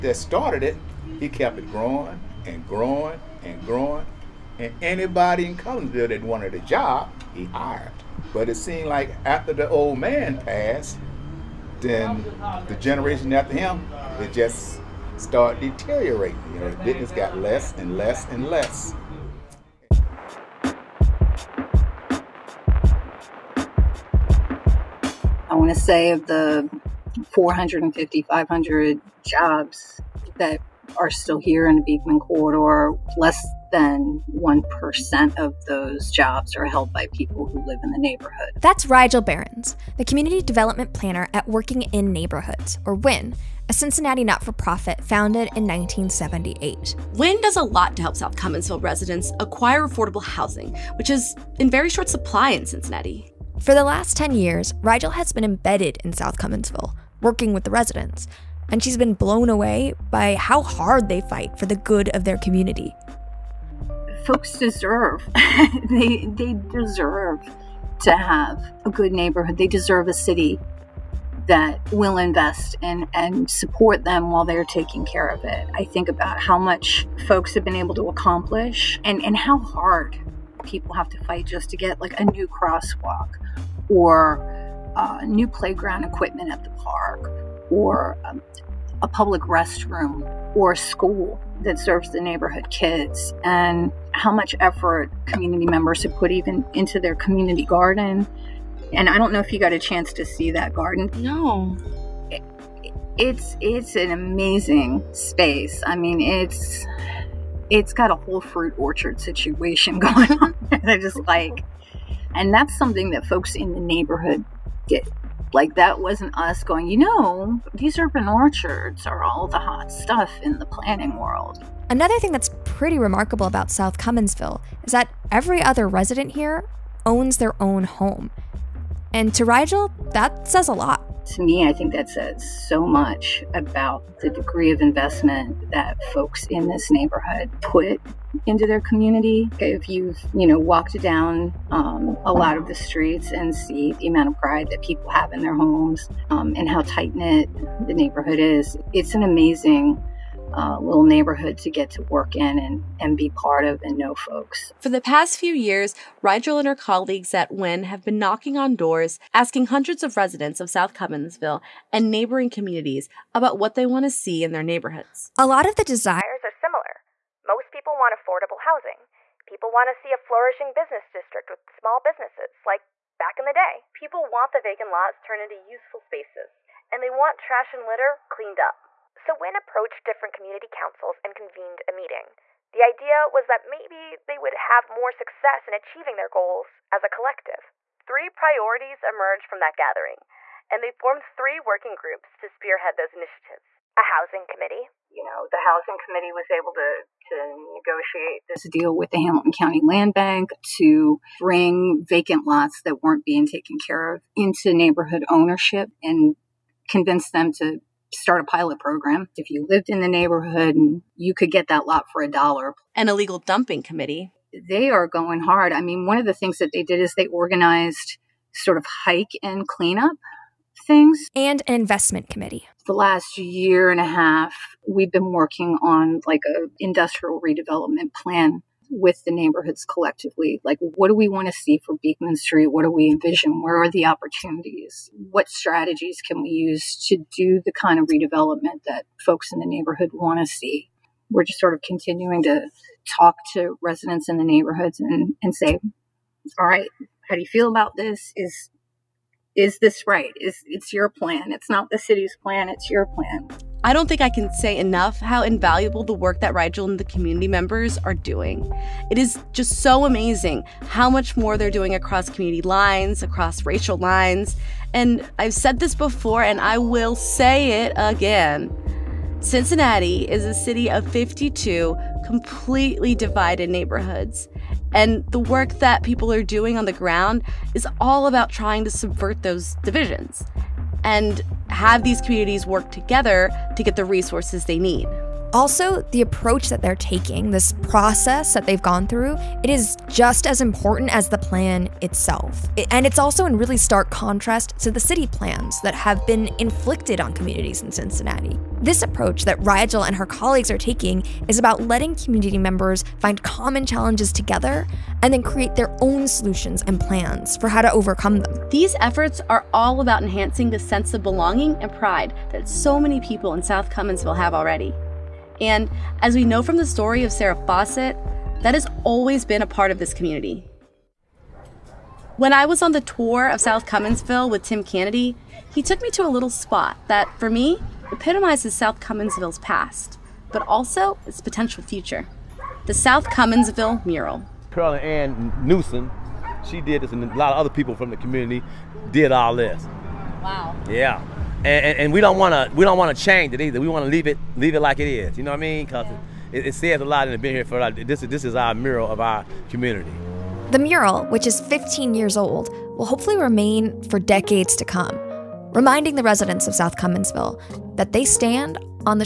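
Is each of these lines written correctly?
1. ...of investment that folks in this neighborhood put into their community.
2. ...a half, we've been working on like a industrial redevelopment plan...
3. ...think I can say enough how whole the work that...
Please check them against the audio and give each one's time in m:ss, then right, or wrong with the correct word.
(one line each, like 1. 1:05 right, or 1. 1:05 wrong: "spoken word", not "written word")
1. 2:14 right
2. 3:44 right
3. 4:14 wrong: "invaluable", not "whole".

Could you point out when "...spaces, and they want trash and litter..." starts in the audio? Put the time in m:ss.
2:55.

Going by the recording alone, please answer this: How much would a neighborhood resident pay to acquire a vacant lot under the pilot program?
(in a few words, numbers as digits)
a dollar.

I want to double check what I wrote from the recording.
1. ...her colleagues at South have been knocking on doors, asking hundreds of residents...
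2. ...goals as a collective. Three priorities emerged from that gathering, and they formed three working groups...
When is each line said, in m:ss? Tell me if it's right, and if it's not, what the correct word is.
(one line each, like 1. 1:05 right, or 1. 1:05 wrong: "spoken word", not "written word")
1. 2:36 wrong: "WIN", not "South"
2. 3:06 right.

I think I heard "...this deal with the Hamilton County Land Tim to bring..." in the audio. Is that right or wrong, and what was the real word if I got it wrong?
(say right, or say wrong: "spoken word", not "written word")
wrong: "Bank", not "Tim".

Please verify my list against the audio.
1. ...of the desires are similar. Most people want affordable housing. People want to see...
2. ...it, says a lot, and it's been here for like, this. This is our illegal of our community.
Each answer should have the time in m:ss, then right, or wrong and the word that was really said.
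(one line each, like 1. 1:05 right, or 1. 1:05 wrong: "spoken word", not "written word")
1. 2:45 right
2. 5:46 wrong: "mural", not "illegal".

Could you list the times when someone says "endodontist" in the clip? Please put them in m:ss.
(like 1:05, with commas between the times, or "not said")
not said.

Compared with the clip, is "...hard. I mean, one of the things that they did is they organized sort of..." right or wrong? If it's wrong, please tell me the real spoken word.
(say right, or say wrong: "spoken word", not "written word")
right.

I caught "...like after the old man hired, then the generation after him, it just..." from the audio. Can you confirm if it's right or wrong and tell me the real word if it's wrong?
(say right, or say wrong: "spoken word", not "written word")
wrong: "passed", not "hired".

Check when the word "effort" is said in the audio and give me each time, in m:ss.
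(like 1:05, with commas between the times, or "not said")
1:34, 5:08.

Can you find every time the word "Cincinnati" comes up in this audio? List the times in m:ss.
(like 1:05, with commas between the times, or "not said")
0:43, 0:52, 4:29, 4:57.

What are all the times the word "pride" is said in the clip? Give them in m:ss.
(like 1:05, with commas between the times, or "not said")
2:24, 5:11.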